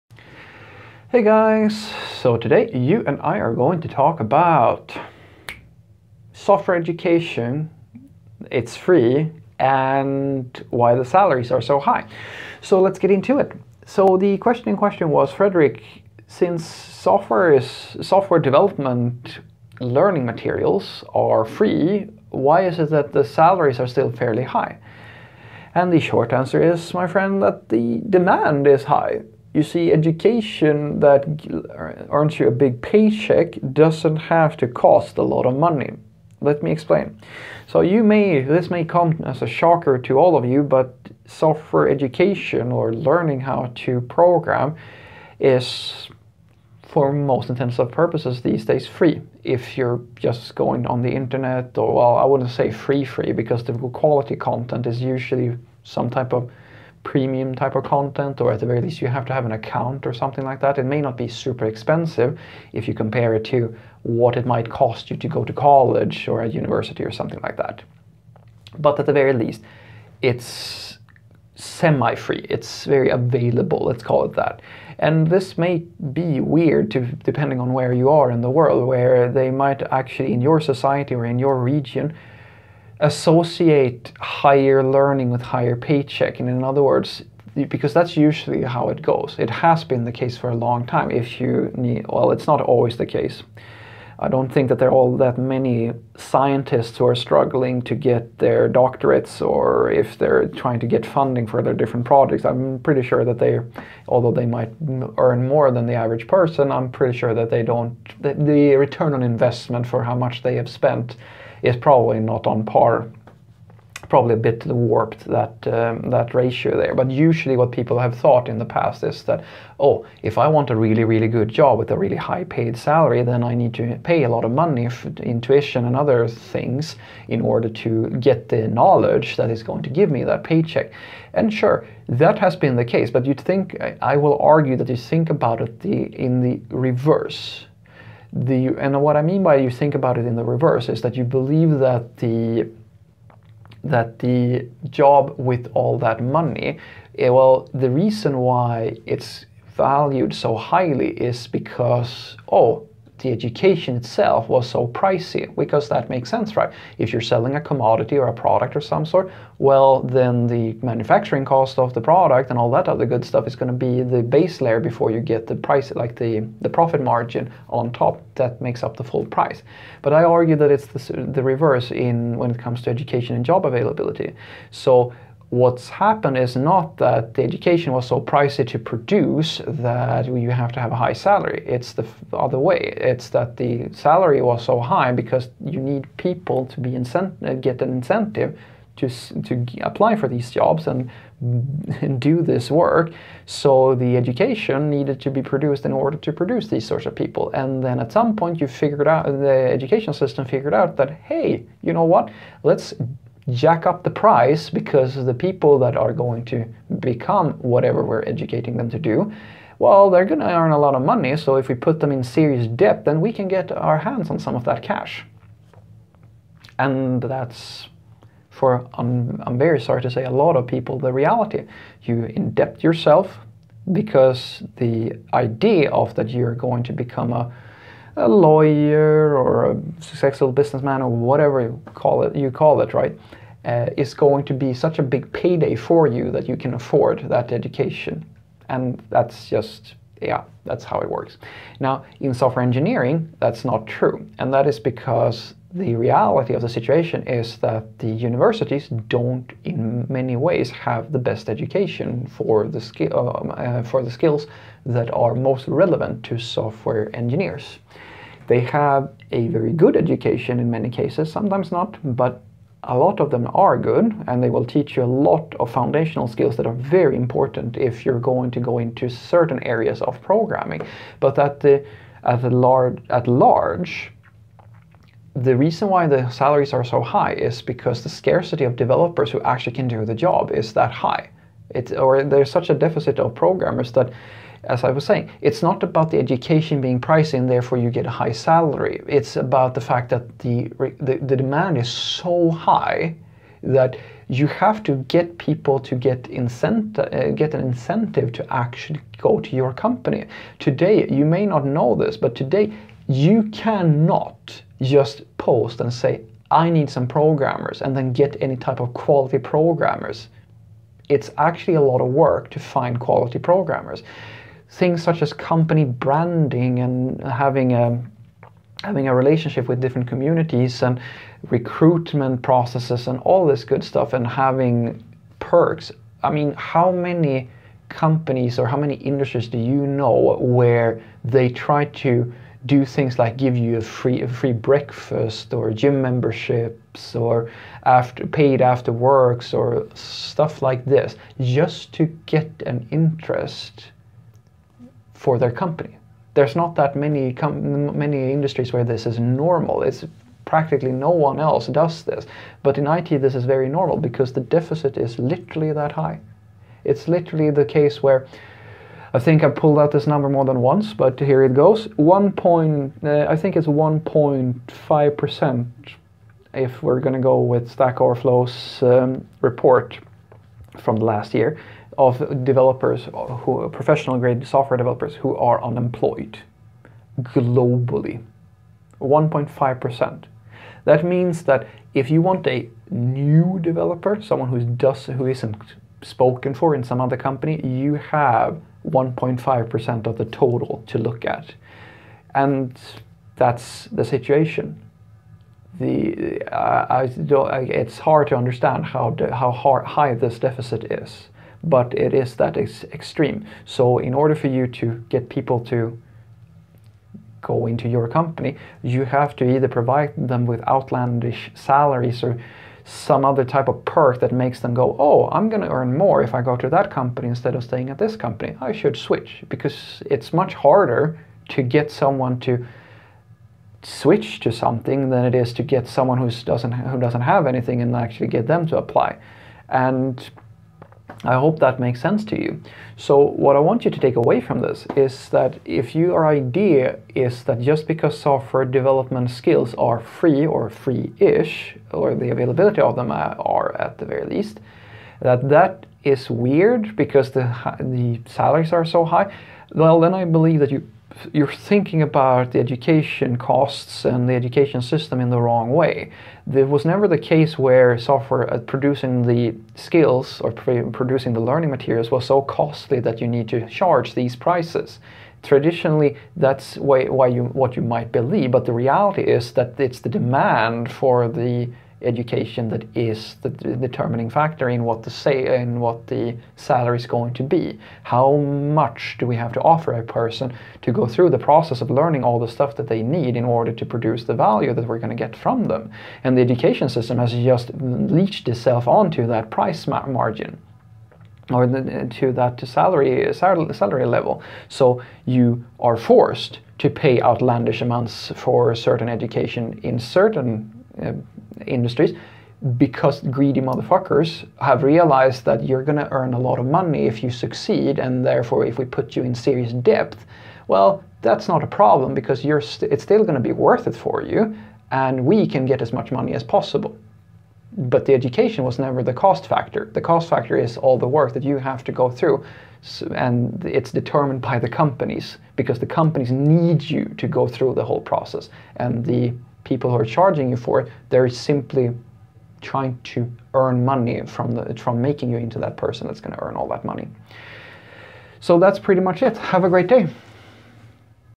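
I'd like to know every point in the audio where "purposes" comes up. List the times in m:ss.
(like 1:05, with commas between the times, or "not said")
0:47.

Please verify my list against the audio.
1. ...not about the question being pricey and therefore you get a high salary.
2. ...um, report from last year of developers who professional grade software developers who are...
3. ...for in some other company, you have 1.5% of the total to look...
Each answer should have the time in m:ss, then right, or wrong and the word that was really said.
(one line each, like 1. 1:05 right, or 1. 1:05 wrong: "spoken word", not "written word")
1. 4:45 wrong: "education", not "question"
2. 6:08 right
3. 6:26 right.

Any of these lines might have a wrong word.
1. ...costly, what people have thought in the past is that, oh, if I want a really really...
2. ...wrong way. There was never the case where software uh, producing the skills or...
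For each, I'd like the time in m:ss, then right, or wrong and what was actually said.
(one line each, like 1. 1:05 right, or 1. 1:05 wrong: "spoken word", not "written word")
1. 1:57 wrong: "usually", not "costly"
2. 7:35 right.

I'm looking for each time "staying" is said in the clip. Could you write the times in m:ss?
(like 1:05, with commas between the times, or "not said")
6:57.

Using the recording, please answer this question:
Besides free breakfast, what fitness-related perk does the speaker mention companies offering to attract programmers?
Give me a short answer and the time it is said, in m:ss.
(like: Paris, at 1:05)
gym memberships, at 5:35.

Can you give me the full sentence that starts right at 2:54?
So what's happened is not that the education was so pricey to produce that you have to have a high salary.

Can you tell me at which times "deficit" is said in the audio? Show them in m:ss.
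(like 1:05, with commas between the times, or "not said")
4:42, 5:54, 6:40.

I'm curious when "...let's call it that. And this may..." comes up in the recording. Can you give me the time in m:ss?
1:13.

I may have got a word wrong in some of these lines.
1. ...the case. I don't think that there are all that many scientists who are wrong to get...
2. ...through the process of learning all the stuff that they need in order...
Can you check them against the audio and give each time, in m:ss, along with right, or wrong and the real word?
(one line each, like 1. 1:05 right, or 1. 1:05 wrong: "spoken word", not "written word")
1. 1:32 wrong: "struggling", not "wrong"
2. 8:01 right.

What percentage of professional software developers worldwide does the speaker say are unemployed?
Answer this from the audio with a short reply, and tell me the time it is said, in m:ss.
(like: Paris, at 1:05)
1.5%, at 6:03.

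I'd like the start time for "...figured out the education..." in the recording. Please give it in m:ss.
3:18.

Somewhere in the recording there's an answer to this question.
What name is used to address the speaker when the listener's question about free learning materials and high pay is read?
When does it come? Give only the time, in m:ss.
0:15.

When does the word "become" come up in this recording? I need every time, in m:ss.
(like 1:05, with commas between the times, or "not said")
3:26, 3:46.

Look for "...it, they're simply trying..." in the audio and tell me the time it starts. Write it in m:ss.
8:50.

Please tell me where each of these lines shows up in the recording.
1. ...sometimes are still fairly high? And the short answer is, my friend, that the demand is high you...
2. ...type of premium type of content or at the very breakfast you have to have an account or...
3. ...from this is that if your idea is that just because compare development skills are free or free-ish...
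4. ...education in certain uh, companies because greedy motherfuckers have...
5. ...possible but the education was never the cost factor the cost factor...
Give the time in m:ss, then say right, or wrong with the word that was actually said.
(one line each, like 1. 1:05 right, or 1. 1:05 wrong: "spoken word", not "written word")
1. 0:23 wrong: "salaries", not "sometimes"
2. 0:56 wrong: "least", not "breakfast"
3. 7:14 wrong: "software", not "compare"
4. 8:19 wrong: "industries", not "companies"
5. 8:36 right.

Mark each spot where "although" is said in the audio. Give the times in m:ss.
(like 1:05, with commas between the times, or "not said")
1:44.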